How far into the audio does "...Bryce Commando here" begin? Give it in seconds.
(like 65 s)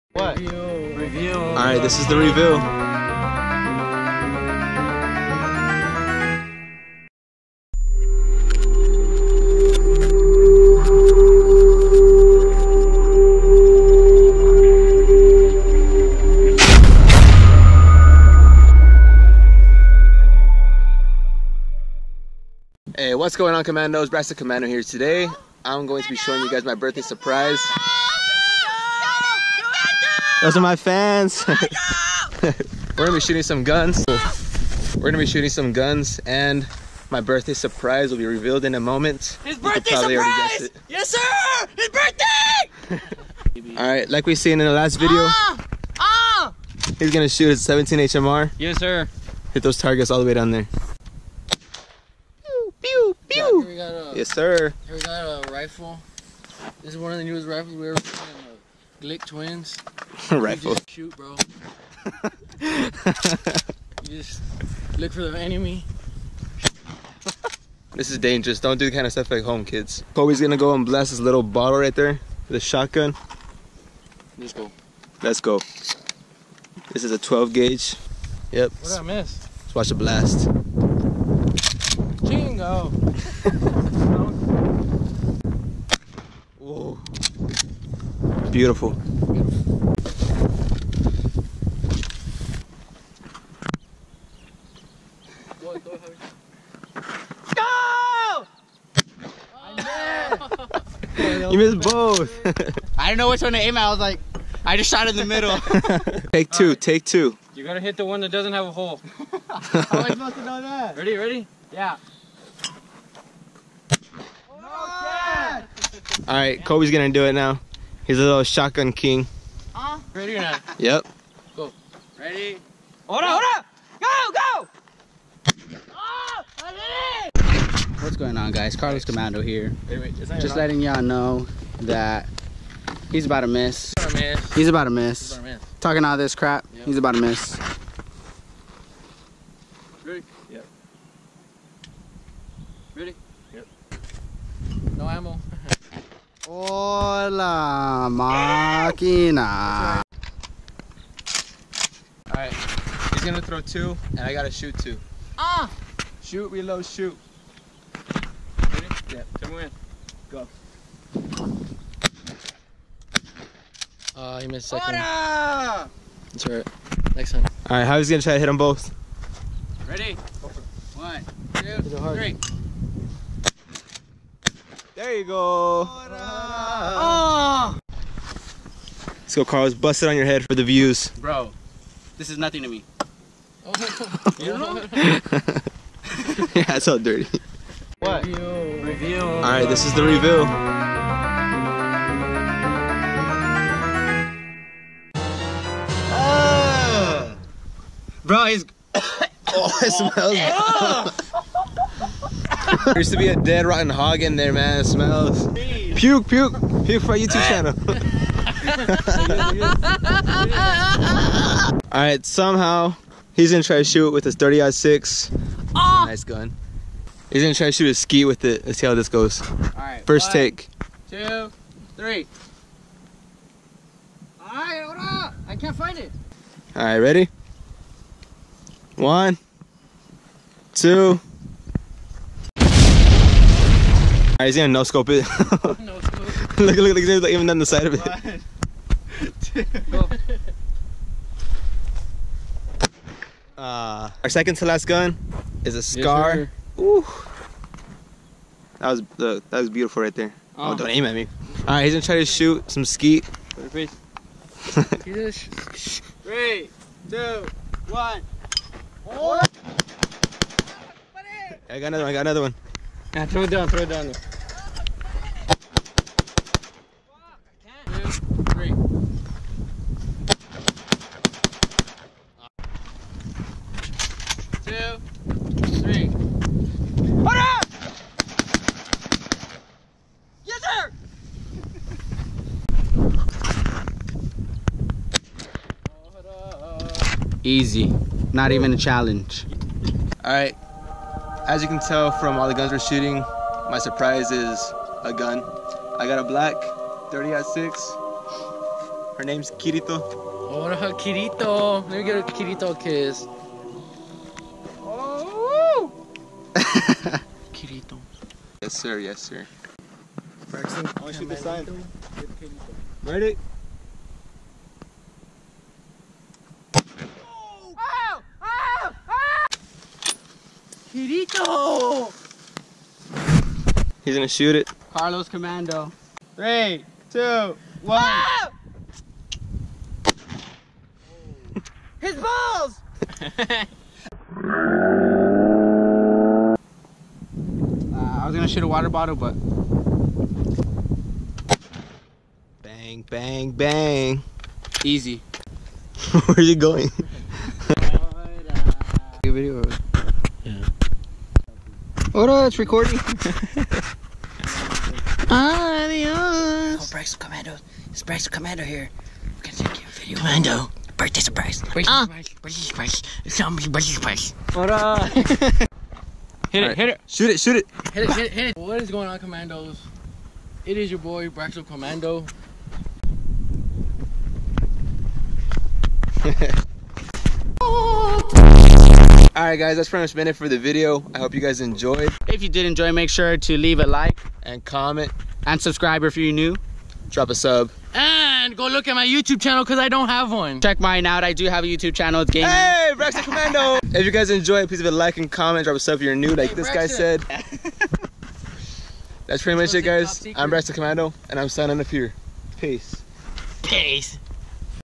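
358 s.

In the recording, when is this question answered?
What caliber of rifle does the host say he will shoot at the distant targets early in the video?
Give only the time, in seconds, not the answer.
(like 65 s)
47 s.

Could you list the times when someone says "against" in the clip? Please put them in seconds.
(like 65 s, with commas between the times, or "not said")
not said.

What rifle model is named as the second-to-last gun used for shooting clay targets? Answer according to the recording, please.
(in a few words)
Scar.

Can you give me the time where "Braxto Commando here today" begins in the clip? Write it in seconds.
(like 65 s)
24 s.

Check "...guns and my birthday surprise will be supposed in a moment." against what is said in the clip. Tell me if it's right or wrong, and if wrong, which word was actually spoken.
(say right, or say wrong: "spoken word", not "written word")
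wrong: "revealed", not "supposed".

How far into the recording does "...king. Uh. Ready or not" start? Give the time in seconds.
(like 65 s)
118 s.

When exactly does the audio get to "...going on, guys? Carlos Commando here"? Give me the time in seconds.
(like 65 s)
128 s.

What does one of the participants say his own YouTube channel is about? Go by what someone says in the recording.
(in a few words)
Gaming.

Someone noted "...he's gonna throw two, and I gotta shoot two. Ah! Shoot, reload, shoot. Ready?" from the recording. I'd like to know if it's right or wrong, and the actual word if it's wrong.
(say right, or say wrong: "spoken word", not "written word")
right.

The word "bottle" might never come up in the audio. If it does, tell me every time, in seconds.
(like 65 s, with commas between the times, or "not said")
71 s, 338 s.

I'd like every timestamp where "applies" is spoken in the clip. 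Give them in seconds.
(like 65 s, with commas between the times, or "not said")
not said.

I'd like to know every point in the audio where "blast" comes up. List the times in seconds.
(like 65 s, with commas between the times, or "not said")
70 s, 79 s.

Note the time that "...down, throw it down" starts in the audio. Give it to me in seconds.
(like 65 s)
263 s.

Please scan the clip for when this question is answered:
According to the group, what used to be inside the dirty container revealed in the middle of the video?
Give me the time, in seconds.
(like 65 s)
203 s.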